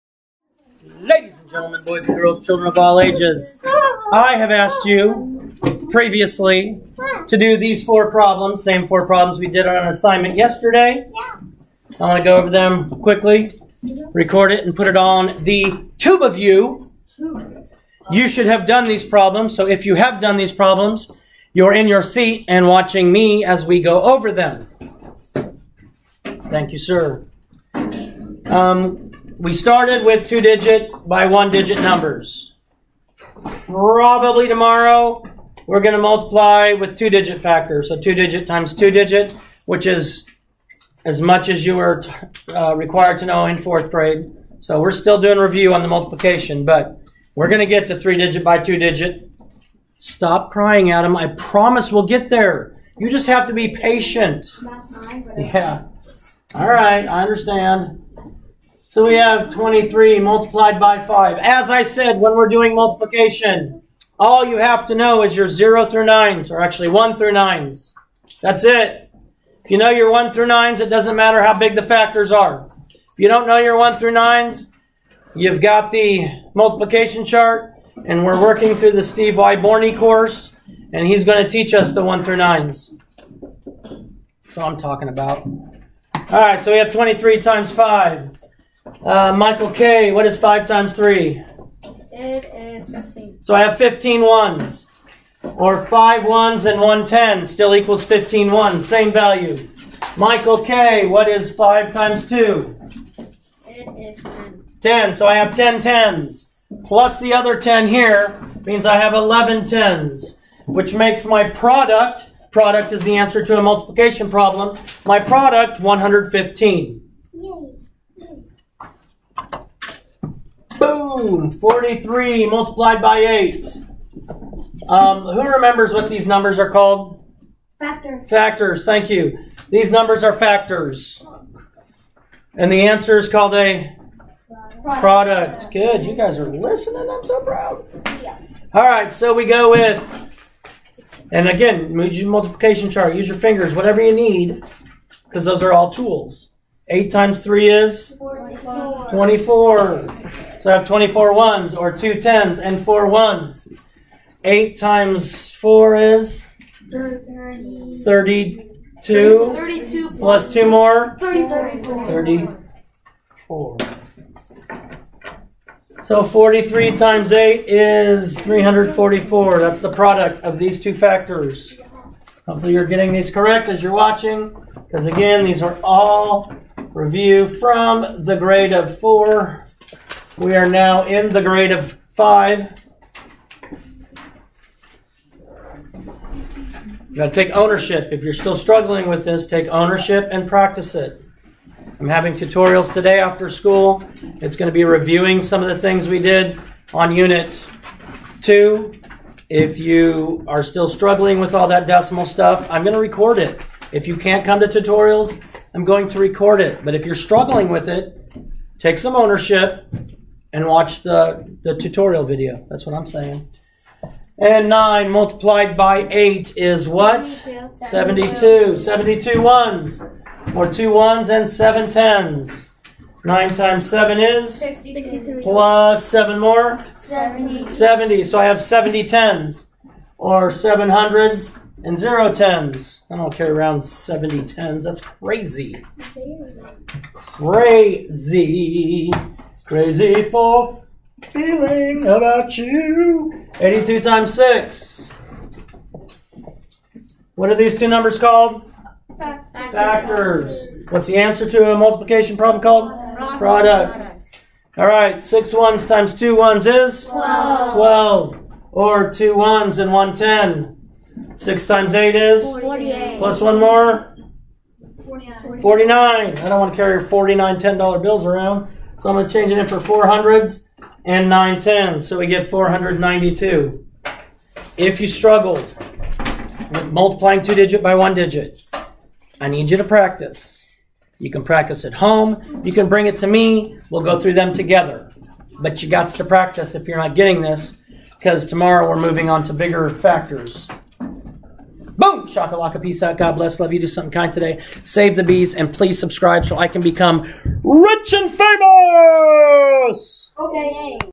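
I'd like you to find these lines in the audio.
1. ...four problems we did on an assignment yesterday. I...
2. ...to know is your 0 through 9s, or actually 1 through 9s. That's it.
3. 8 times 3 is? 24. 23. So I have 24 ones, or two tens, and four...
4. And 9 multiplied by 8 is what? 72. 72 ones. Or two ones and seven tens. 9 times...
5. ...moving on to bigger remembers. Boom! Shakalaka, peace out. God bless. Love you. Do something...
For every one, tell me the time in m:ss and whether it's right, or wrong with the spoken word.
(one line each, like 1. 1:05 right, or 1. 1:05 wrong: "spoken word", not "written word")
1. 0:08 right
2. 1:04 right
3. 2:26 wrong: "24", not "23"
4. 3:34 right
5. 4:49 wrong: "factors", not "remembers".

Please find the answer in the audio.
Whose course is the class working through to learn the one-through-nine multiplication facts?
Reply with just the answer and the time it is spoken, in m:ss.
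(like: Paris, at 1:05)
Steve Wyborney, at 1:19.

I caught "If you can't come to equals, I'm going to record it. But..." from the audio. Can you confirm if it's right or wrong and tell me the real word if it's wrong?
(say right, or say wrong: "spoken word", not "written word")
wrong: "tutorials", not "equals".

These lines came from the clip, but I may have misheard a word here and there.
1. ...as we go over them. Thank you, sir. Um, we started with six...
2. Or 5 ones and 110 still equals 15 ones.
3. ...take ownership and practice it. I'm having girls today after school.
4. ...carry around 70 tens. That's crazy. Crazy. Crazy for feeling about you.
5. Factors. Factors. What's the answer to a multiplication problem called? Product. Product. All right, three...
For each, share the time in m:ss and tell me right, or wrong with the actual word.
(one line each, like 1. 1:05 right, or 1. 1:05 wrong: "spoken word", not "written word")
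1. 0:23 wrong: "two", not "six"
2. 1:35 right
3. 3:09 wrong: "tutorials", not "girls"
4. 3:53 right
5. 4:09 wrong: "six", not "three".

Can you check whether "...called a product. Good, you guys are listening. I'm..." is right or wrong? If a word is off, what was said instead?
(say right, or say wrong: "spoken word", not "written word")
right.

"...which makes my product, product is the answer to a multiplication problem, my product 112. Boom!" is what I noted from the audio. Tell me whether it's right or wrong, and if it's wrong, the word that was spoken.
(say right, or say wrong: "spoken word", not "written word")
wrong: "115", not "112".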